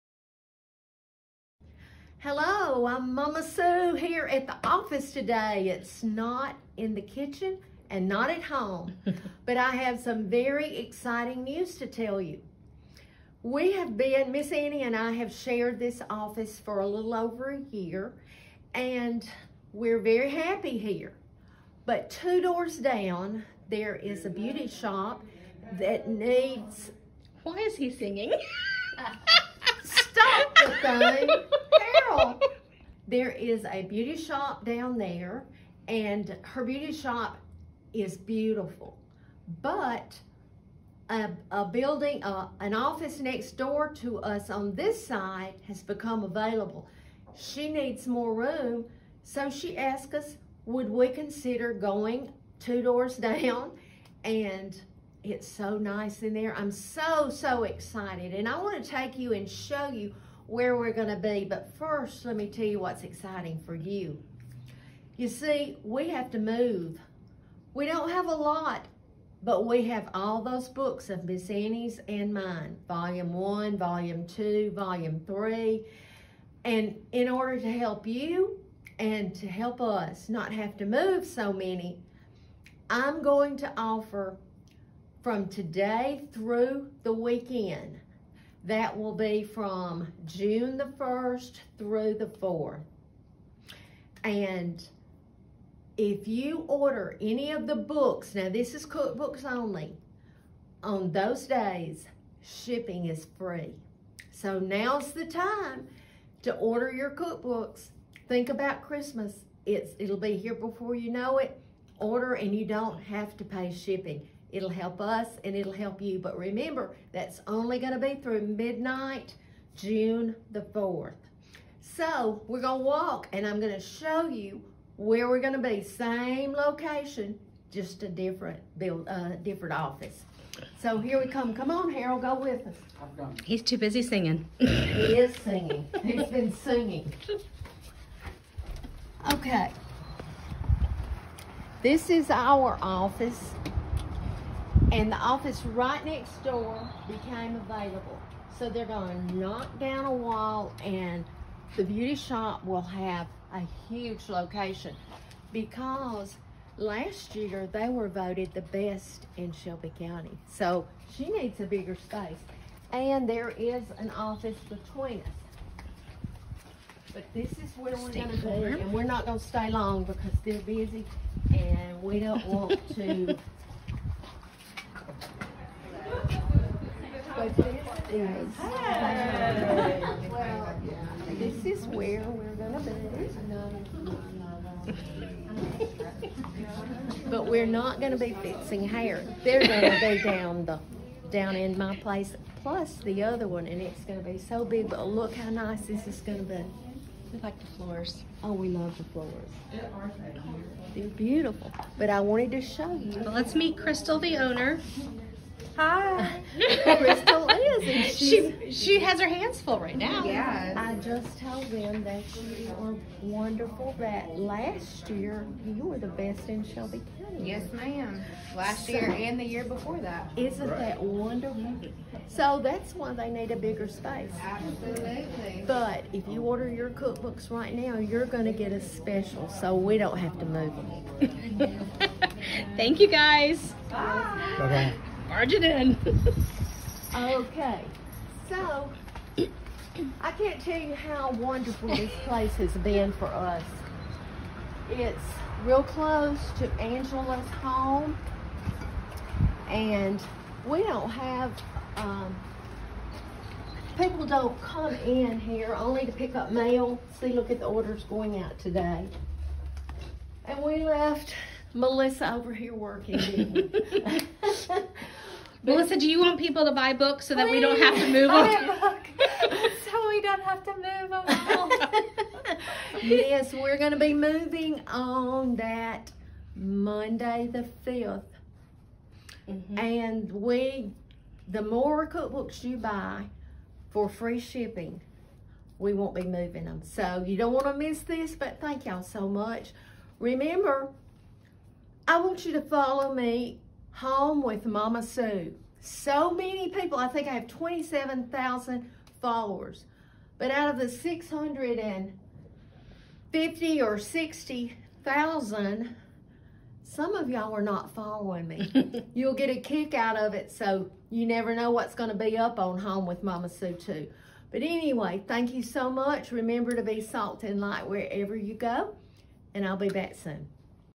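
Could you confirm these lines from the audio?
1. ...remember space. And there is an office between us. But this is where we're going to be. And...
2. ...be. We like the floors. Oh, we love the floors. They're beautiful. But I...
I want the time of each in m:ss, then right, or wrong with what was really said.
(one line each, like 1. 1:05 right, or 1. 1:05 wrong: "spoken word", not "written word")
1. 2:41 wrong: "bigger", not "remember"
2. 3:16 right.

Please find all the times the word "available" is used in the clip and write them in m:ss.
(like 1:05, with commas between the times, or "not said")
0:46, 2:27.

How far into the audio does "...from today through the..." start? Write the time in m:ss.
1:25.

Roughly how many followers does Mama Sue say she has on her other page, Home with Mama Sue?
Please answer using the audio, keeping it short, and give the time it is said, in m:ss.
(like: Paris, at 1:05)
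27,000, at 4:57.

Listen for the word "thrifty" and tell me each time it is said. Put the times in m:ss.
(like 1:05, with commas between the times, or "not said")
not said.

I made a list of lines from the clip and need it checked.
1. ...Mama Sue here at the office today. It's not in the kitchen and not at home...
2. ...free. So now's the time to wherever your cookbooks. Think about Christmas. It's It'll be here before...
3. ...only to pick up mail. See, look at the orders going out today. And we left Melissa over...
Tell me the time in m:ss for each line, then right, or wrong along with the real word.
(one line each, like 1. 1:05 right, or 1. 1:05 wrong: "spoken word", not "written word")
1. 0:03 right
2. 1:43 wrong: "order", not "wherever"
3. 4:15 right.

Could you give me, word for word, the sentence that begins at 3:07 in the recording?
But we're not gonna be fixing hair.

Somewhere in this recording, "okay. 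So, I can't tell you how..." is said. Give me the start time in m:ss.
3:57.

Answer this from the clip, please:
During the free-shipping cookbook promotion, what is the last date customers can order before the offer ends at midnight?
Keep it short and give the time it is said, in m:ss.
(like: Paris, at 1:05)
June 4th, at 1:59.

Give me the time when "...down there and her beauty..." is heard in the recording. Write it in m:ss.
0:34.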